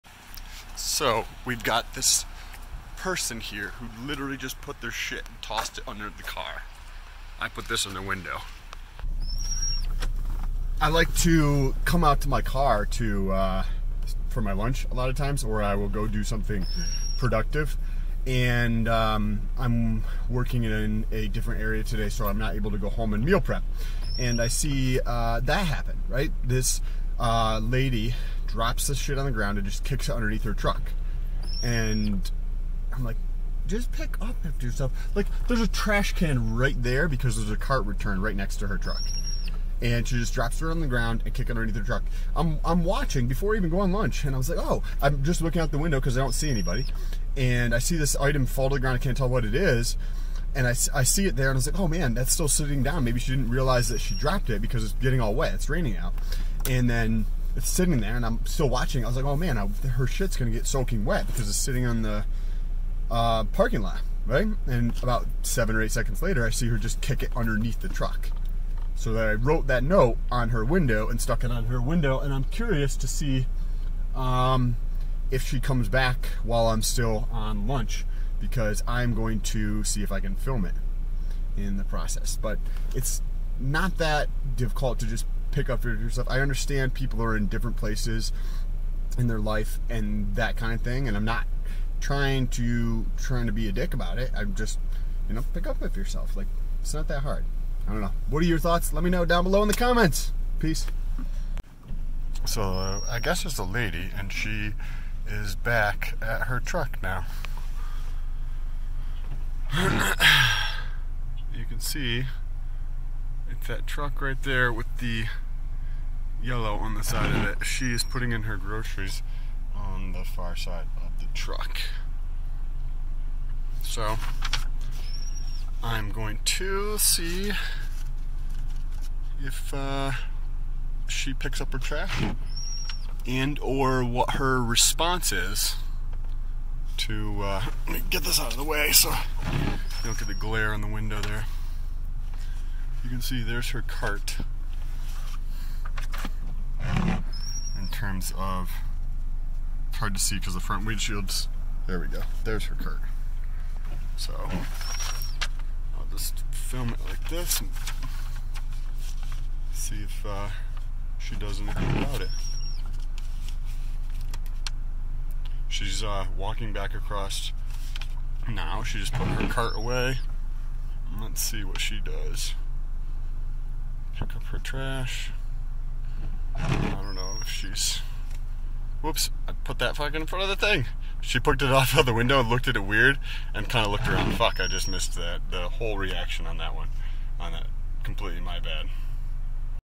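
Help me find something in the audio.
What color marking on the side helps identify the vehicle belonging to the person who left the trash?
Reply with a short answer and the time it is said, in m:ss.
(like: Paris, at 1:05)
Yellow, at 1:56.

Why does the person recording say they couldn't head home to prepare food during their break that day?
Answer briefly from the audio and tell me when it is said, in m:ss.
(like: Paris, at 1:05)
Working in a different area, at 0:20.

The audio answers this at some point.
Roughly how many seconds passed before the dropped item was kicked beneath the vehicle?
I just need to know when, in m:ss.
1:05.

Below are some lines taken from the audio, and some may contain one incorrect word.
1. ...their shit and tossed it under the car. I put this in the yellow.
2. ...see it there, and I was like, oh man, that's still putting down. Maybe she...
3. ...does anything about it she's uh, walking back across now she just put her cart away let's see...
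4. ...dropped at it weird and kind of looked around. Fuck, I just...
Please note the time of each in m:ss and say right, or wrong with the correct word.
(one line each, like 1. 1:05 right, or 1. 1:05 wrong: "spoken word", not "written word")
1. 0:04 wrong: "window", not "yellow"
2. 0:51 wrong: "sitting", not "putting"
3. 2:41 right
4. 3:02 wrong: "looked", not "dropped".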